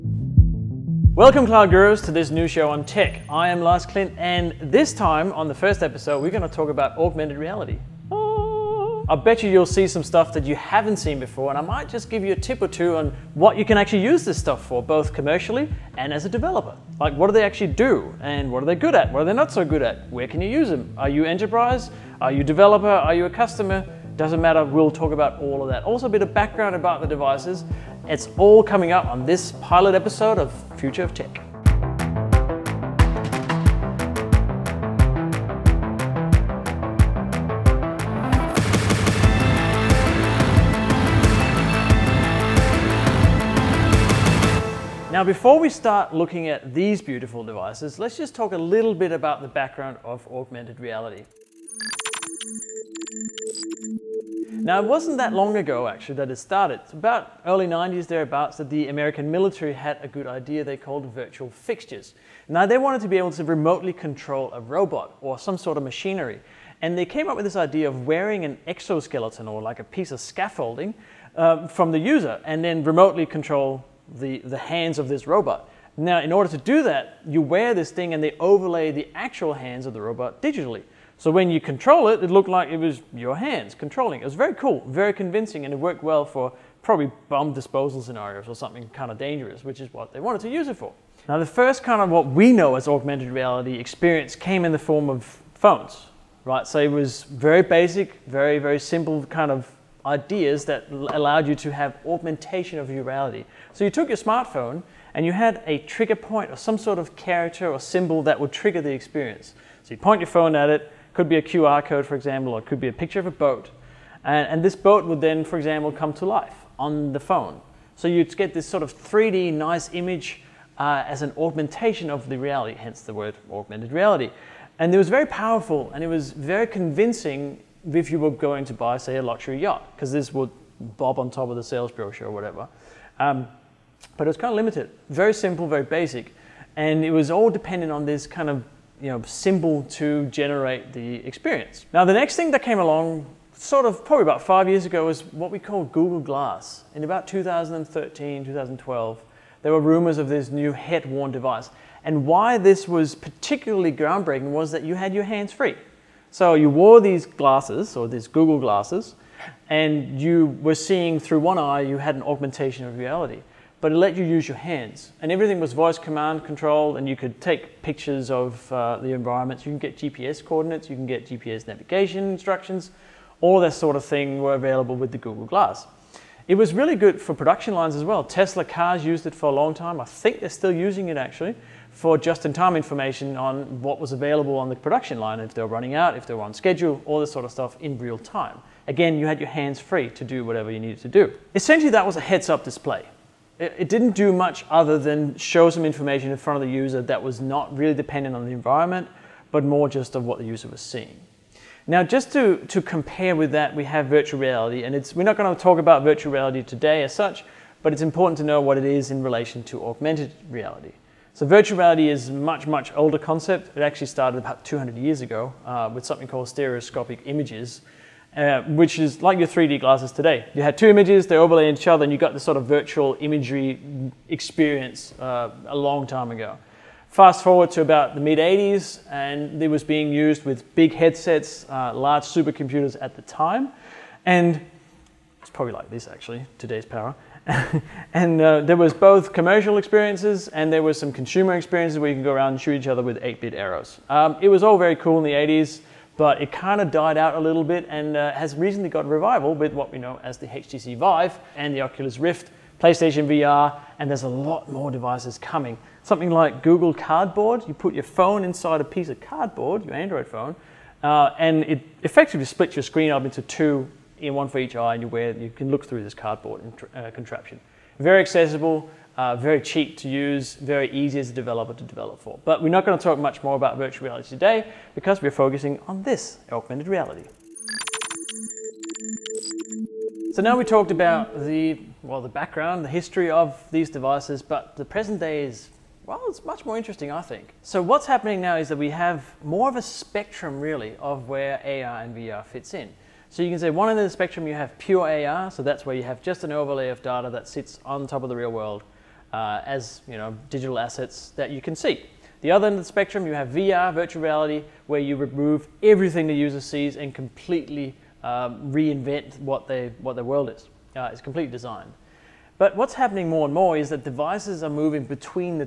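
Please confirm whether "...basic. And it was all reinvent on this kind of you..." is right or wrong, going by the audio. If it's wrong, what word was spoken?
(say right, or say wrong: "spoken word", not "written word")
wrong: "dependent", not "reinvent".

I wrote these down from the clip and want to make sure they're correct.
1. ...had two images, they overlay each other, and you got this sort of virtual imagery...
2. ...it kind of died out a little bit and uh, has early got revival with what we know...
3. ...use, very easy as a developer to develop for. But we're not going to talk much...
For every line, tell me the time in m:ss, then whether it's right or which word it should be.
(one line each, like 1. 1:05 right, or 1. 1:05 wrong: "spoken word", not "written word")
1. 3:40 right
2. 4:06 wrong: "recently", not "early"
3. 4:30 right.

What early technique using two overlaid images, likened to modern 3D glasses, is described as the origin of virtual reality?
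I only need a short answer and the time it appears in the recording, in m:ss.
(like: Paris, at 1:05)
Stereoscopic images, at 3:36.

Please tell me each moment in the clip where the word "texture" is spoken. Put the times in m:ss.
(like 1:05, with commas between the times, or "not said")
not said.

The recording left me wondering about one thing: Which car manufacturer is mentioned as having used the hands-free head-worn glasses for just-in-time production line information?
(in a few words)
Tesla.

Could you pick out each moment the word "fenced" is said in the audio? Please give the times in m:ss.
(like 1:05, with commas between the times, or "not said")
not said.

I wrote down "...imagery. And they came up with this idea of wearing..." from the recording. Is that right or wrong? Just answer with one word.
wrong.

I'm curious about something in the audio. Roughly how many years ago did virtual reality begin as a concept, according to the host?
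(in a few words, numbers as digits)
200 years.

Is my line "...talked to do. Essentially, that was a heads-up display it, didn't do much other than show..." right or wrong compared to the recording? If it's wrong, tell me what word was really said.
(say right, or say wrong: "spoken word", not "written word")
wrong: "needed", not "talked".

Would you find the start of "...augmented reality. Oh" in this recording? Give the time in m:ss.
0:06.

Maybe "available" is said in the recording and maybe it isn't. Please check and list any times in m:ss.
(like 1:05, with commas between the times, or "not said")
2:54, 3:04.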